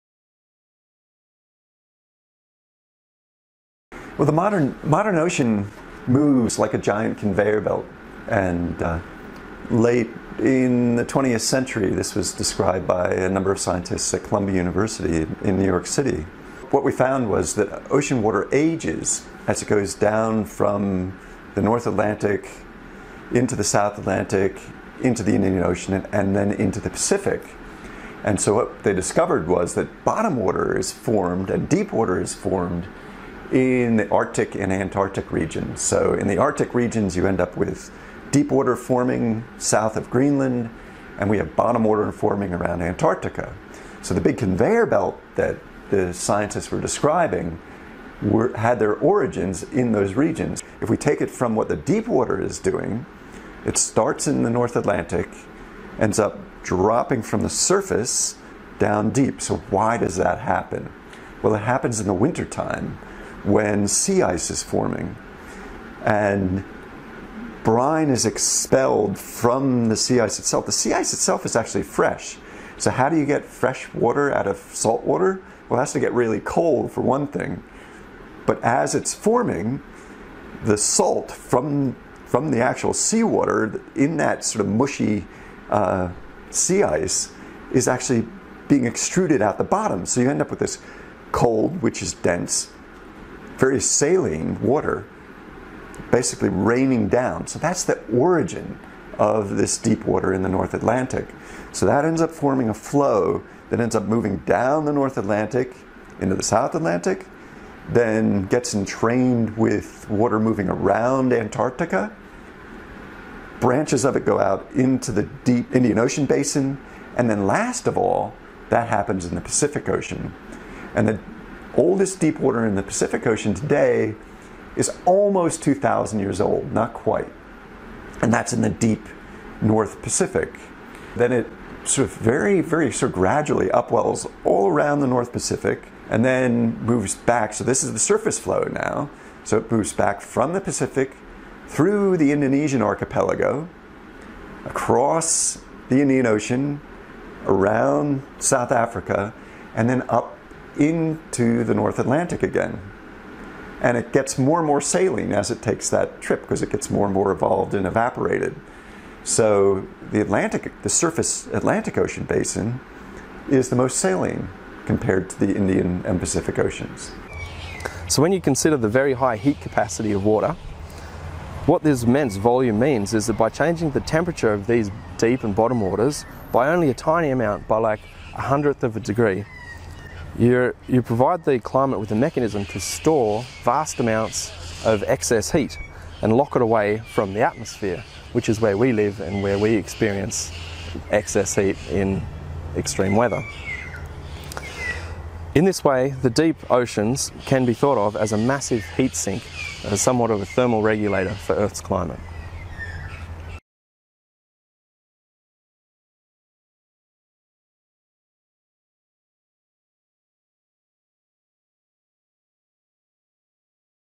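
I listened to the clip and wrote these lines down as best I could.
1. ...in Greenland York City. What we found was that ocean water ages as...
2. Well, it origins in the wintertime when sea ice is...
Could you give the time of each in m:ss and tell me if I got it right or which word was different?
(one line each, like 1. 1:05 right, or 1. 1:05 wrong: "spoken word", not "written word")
1. 0:15 wrong: "New", not "Greenland"
2. 1:01 wrong: "happens", not "origins".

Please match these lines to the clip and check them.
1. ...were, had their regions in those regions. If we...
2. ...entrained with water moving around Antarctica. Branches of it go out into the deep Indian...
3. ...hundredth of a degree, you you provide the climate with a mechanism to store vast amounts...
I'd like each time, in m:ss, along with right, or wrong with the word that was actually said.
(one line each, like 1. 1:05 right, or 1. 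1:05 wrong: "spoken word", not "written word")
1. 0:48 wrong: "origins", not "regions"
2. 1:48 right
3. 2:58 right.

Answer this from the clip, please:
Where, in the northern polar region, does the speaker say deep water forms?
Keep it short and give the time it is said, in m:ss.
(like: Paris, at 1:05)
South of Greenland, at 0:39.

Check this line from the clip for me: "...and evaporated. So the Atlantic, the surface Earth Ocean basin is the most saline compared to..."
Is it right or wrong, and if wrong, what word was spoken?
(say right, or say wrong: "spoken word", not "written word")
wrong: "Atlantic", not "Earth".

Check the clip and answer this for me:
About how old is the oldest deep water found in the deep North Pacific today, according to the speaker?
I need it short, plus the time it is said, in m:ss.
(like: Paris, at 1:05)
Almost 2,000 years, at 2:05.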